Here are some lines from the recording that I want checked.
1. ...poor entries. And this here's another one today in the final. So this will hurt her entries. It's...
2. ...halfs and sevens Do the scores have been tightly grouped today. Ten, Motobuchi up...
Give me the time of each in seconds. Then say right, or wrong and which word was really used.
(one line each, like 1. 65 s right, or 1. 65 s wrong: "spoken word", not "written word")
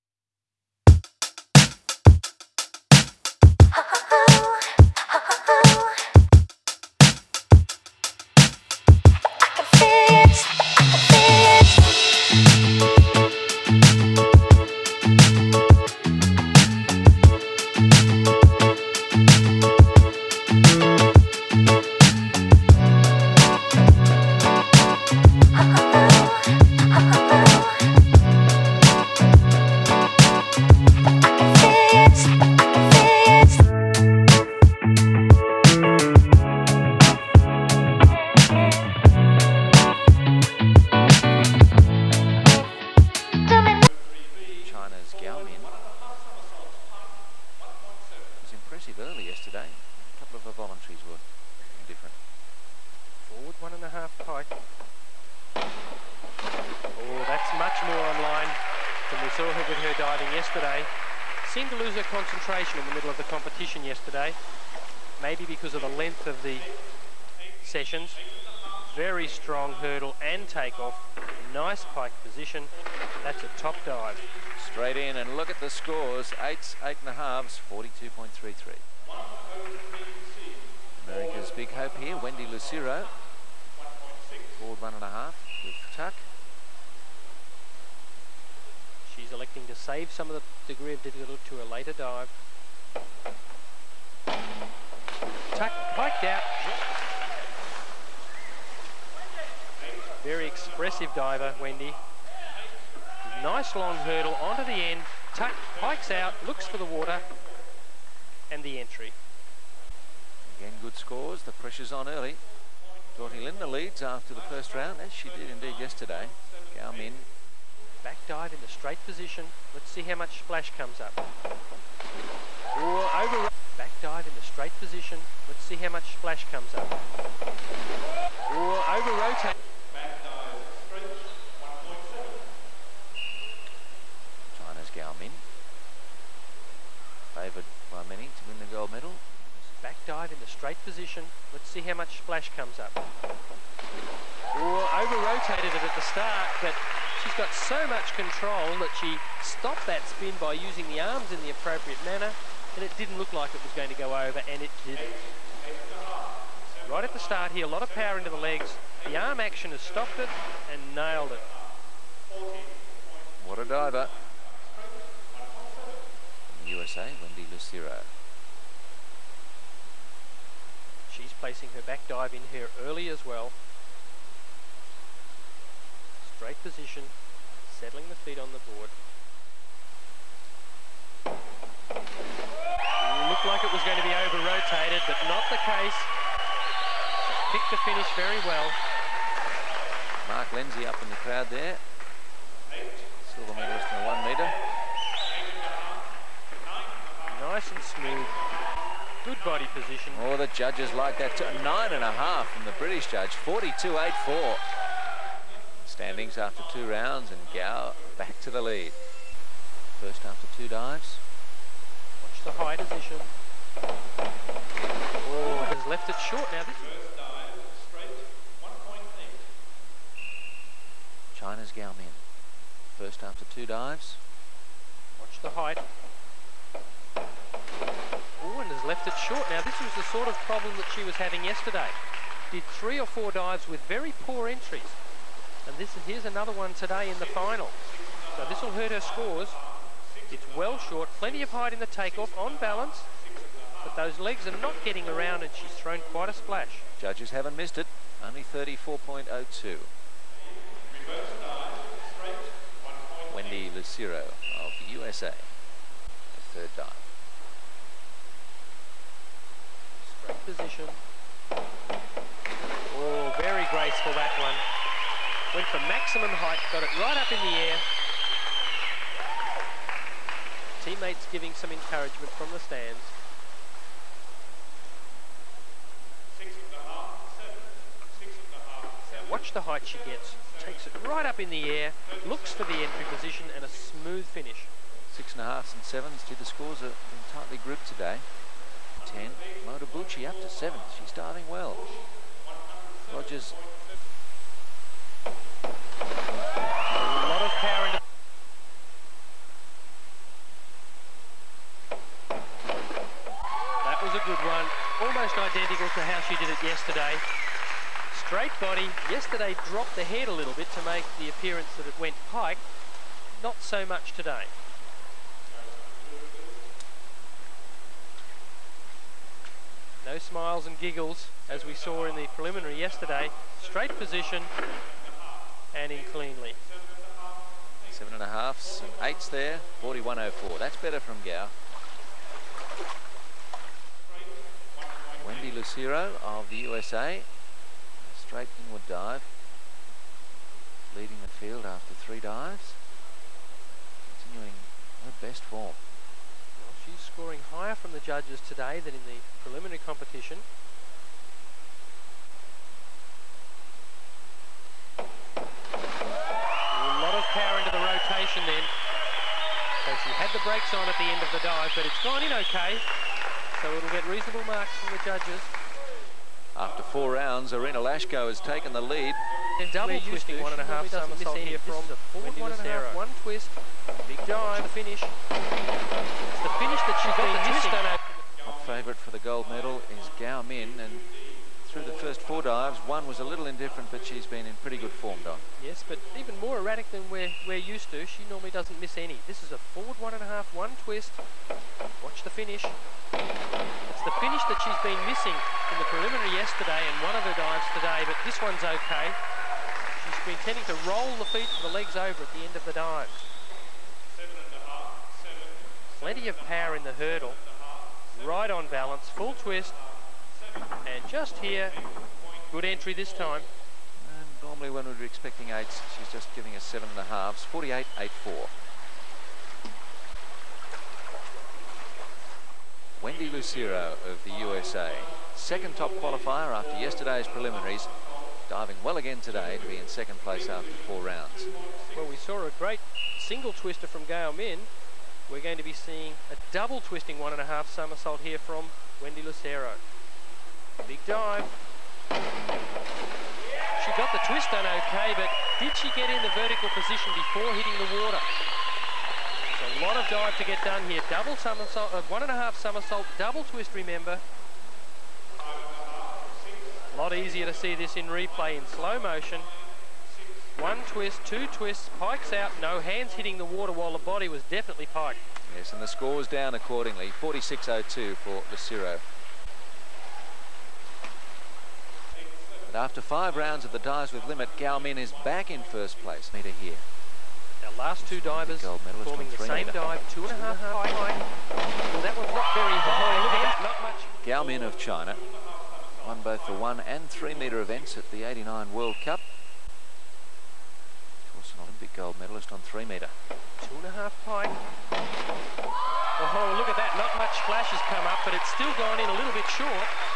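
1. 234 s wrong: "scores", not "entries"
2. 285 s right.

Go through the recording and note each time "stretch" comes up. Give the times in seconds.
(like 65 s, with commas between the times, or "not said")
130 s.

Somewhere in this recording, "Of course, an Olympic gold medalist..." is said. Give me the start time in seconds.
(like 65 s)
491 s.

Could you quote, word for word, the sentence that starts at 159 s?
The arm action has stopped it and nailed it.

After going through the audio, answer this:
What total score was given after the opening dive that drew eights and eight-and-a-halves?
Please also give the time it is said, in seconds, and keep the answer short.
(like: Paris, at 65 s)
42.33, at 77 s.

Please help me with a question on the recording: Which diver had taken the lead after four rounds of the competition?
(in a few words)
Irina Lashko.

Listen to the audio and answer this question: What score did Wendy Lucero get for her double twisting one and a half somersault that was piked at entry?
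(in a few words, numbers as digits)
46.02.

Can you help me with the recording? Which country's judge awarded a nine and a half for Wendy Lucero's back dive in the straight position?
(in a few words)
British.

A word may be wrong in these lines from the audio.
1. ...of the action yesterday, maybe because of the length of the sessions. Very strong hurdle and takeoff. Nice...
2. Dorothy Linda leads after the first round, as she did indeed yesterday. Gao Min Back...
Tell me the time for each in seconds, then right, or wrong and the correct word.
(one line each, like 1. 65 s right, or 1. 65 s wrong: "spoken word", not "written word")
1. 63 s wrong: "competition", not "action"
2. 113 s right.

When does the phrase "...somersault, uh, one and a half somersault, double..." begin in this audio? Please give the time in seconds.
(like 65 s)
451 s.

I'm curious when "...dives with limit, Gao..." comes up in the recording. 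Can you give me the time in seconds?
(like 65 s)
473 s.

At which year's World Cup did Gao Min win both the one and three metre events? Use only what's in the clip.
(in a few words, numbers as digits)
1989.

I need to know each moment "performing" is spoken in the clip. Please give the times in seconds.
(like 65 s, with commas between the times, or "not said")
478 s.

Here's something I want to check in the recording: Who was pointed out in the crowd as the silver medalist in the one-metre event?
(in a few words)
Mark Lindsay.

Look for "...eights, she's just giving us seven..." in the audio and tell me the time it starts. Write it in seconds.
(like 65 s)
415 s.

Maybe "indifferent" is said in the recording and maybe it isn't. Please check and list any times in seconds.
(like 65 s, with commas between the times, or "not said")
383 s.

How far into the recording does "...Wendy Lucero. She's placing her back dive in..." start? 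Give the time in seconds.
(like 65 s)
167 s.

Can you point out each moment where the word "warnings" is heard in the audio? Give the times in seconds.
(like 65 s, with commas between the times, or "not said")
not said.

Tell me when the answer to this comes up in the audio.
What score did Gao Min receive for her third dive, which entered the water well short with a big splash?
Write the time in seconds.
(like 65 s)
248 s.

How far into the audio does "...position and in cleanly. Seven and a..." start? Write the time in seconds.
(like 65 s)
323 s.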